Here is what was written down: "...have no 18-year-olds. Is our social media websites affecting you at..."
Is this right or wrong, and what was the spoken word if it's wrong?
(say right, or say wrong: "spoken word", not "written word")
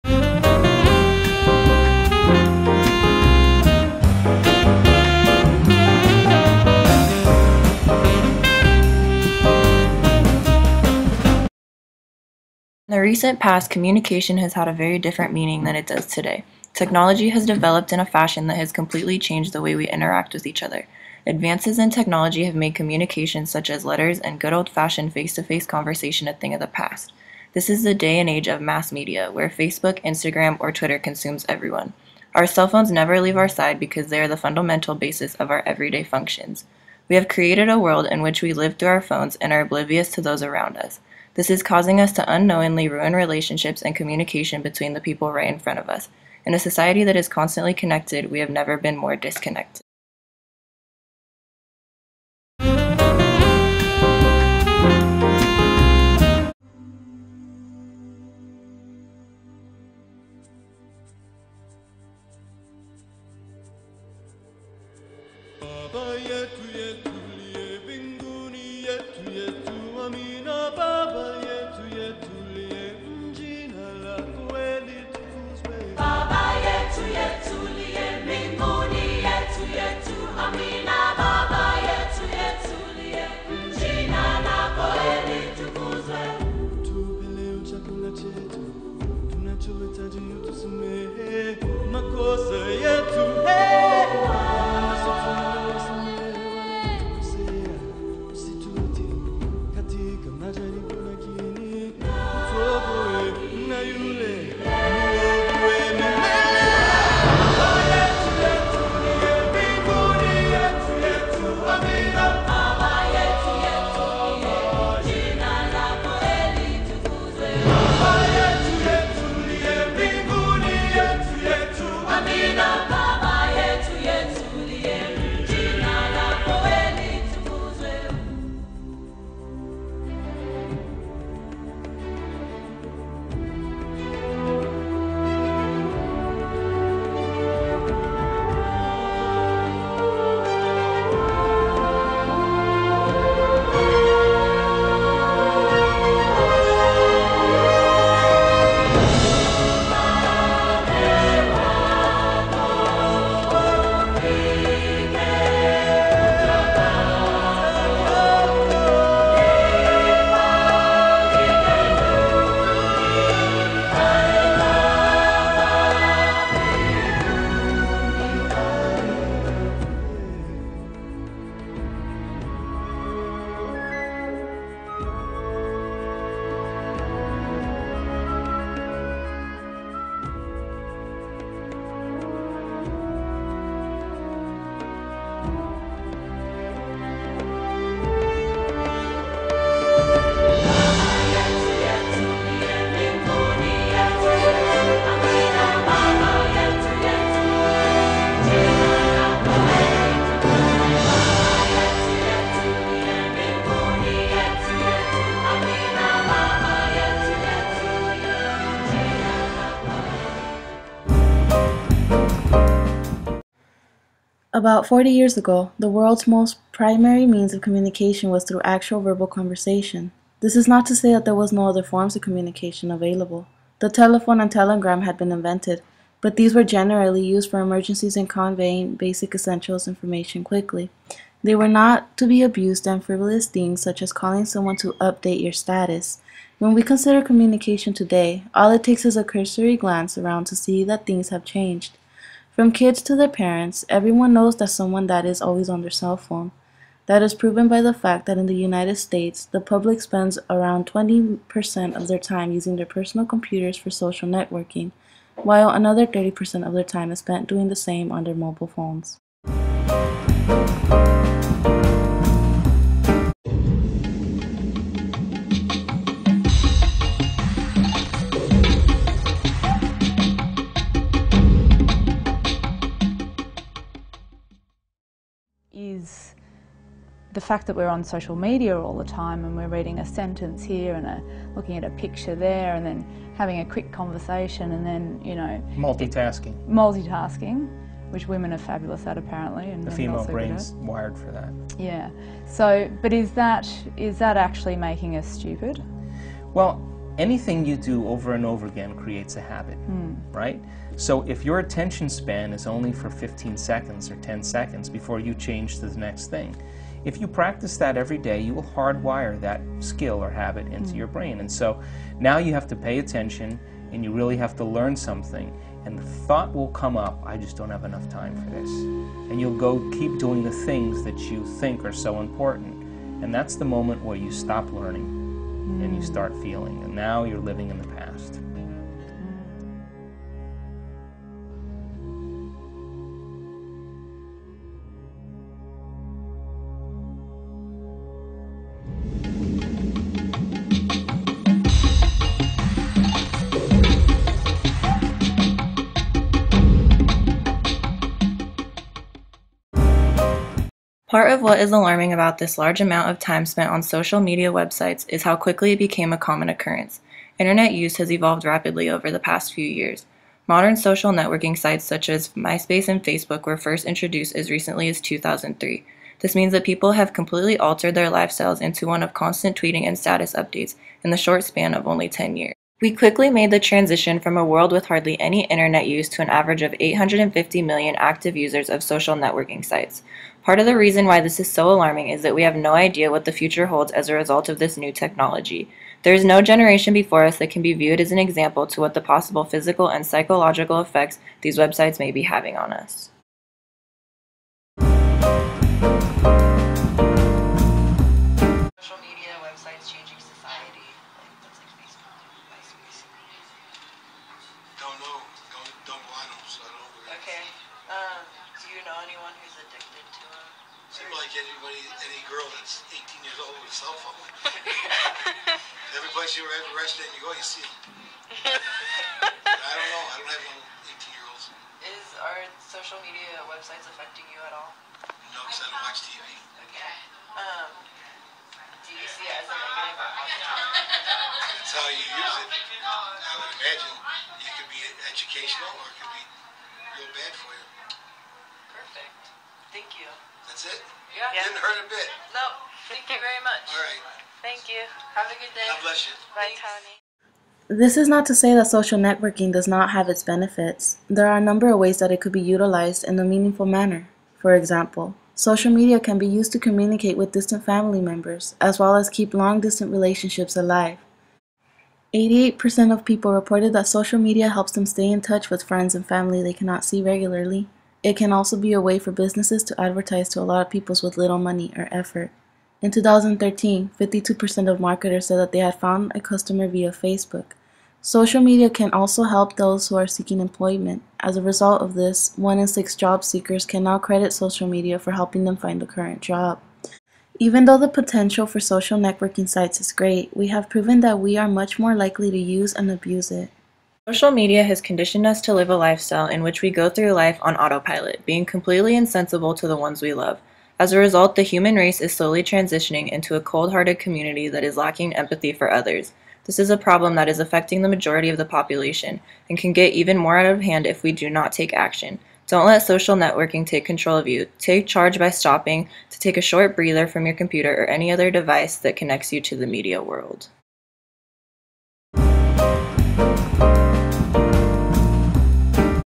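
right.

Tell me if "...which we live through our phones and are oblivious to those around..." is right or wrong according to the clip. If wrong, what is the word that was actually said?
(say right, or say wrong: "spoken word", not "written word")
right.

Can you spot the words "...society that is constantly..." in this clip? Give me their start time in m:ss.
0:46.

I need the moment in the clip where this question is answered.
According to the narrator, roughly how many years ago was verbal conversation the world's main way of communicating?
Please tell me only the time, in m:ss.
3:34.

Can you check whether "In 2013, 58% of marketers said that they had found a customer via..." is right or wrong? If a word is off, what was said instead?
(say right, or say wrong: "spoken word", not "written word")
wrong: "52", not "58".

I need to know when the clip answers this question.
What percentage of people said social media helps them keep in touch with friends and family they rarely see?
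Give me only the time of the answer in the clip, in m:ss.
7:42.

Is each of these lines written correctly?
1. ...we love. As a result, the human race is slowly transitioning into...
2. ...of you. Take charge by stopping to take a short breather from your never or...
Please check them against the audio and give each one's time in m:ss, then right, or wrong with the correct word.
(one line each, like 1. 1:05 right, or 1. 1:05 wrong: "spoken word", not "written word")
1. 8:20 right
2. 8:34 wrong: "computer", not "never".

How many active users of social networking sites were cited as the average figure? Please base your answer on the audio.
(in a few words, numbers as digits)
850 million.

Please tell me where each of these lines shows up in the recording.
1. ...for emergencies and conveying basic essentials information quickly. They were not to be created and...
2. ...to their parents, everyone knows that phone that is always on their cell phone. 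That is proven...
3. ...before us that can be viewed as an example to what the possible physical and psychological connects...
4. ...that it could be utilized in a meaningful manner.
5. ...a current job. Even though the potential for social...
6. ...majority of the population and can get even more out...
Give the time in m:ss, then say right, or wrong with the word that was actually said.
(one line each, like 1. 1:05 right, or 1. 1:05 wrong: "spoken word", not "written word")
1. 3:47 wrong: "abused", not "created"
2. 4:03 wrong: "someone", not "phone"
3. 6:26 wrong: "effects", not "connects"
4. 7:31 right
5. 8:05 right
6. 8:27 right.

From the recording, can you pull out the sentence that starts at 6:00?
Modern social networking sites such as MySpace and Facebook were first introduced as recently as 2003.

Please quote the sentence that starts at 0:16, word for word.
Technology has developed in a fashion that has completely changed the way we interact with each other.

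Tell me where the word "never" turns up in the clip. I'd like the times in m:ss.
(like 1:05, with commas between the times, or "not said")
0:32, 0:48.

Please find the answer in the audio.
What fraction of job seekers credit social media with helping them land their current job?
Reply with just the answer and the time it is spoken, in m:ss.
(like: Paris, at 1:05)
1 in 6, at 8:02.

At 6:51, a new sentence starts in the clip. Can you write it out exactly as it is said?
like anybody, any girl that's 18 years old with a cell phone.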